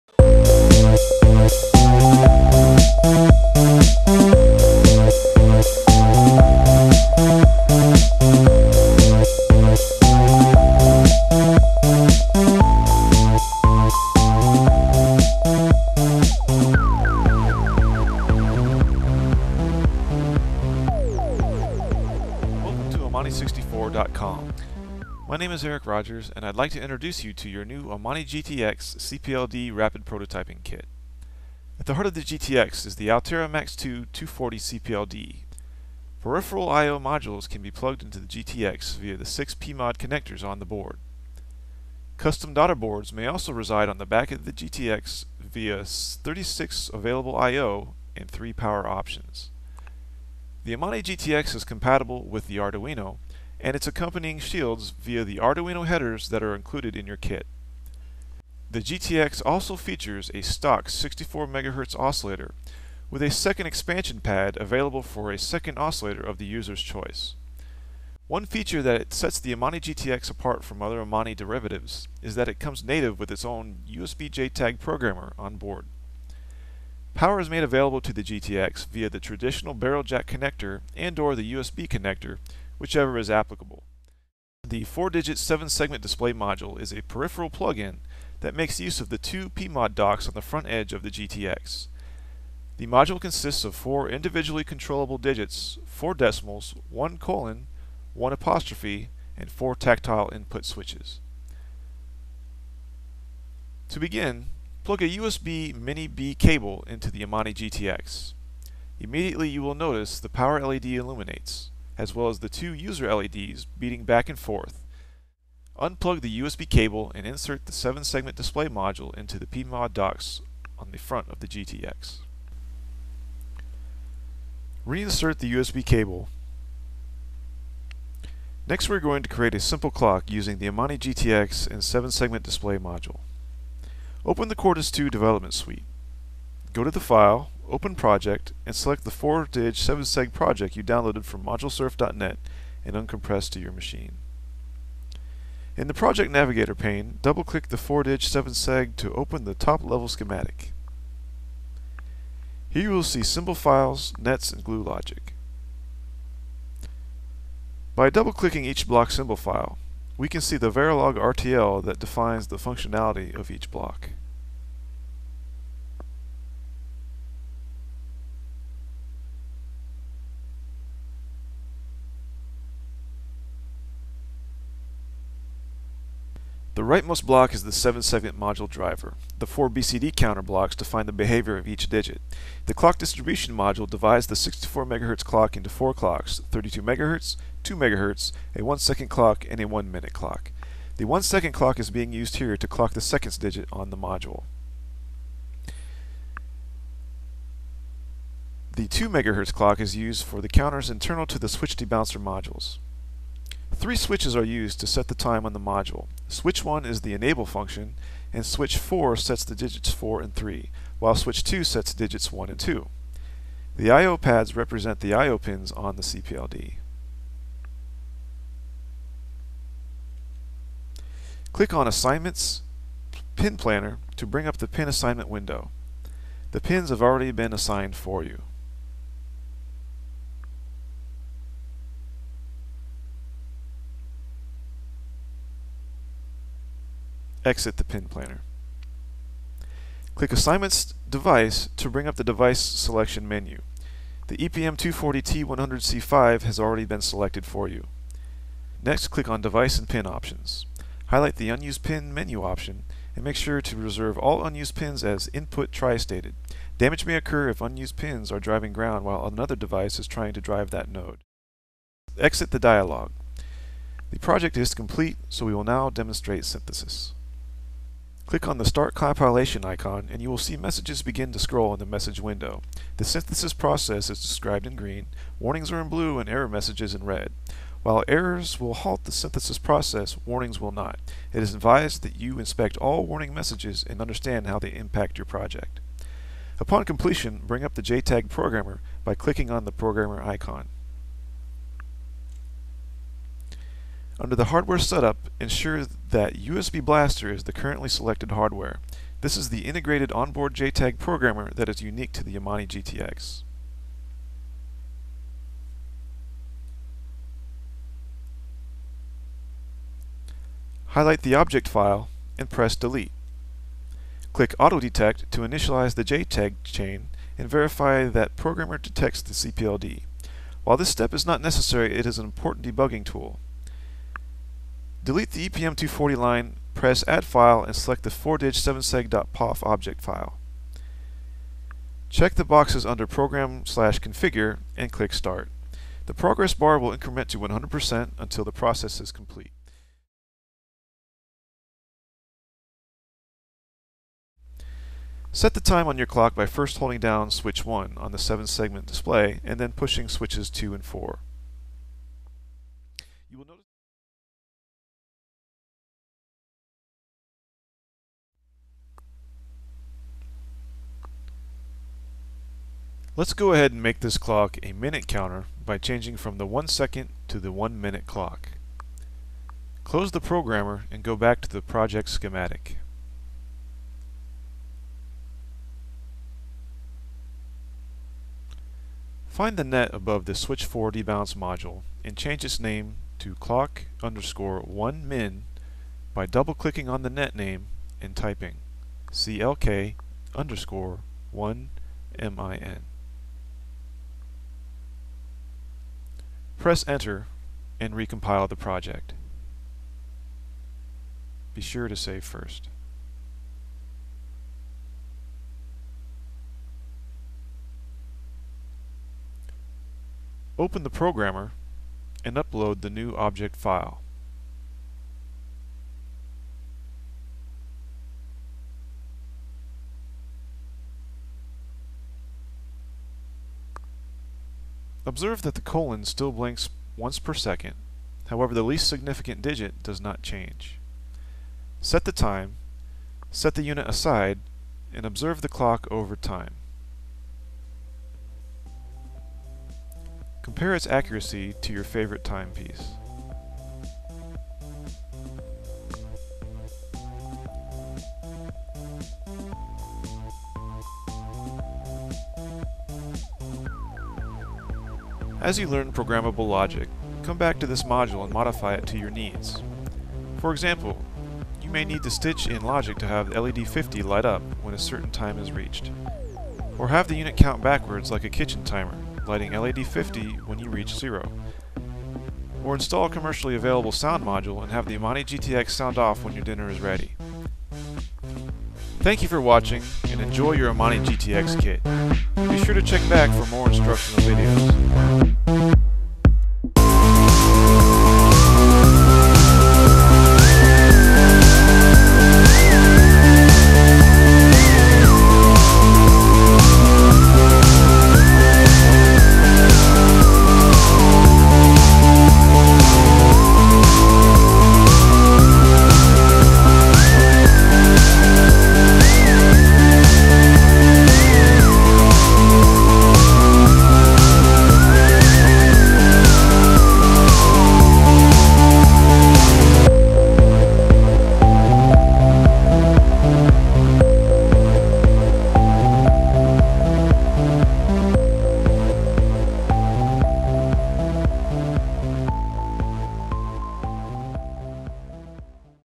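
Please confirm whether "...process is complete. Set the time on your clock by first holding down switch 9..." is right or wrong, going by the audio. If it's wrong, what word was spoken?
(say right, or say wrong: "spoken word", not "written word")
wrong: "1", not "9".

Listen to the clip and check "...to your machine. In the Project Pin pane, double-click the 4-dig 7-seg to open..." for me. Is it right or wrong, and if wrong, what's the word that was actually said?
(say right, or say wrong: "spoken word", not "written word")
wrong: "Navigator", not "Pin".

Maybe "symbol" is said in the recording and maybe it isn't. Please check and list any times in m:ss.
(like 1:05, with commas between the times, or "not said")
2:33, 2:39.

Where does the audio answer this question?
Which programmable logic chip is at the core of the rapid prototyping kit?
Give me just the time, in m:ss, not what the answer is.
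0:33.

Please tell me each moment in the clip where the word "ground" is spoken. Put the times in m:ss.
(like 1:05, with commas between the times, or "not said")
4:18.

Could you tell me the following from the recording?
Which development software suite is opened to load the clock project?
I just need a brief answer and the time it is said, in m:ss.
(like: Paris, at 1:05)
Quartus 2, at 2:14.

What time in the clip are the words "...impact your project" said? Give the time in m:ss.
4:44.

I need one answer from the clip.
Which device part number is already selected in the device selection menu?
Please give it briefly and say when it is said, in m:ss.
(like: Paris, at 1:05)
EPM240T100C5, at 4:04.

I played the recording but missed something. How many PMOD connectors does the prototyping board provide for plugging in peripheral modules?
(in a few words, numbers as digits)
6.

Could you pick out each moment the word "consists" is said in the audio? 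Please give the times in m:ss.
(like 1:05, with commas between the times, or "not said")
1:33.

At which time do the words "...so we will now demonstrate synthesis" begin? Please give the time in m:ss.
4:25.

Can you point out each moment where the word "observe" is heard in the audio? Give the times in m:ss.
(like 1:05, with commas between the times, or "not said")
7:05, 7:15.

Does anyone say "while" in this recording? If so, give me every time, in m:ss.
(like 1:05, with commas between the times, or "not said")
3:30, 4:19, 4:37, 5:20.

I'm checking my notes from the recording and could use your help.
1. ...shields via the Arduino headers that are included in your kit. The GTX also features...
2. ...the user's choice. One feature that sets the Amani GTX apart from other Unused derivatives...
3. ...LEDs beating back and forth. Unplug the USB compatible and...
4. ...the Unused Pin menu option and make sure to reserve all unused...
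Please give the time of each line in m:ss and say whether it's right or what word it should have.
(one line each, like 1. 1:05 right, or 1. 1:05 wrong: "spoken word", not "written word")
1. 0:54 right
2. 1:06 wrong: "Amani", not "Unused"
3. 1:53 wrong: "cable", not "compatible"
4. 4:11 right.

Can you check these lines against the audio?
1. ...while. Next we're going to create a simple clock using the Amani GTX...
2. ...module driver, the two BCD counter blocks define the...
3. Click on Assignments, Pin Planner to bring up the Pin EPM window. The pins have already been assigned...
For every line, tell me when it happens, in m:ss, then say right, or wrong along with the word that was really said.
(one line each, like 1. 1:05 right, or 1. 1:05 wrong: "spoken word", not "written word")
1. 2:05 wrong: "cable", not "while"
2. 2:58 wrong: "four", not "two"
3. 3:41 wrong: "Assignment", not "EPM".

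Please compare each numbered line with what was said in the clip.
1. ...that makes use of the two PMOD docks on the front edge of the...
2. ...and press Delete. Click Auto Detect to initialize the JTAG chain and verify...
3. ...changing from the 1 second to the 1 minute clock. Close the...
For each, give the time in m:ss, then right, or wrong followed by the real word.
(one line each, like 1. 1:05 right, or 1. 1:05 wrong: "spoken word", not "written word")
1. 1:28 right
2. 5:12 right
3. 6:05 right.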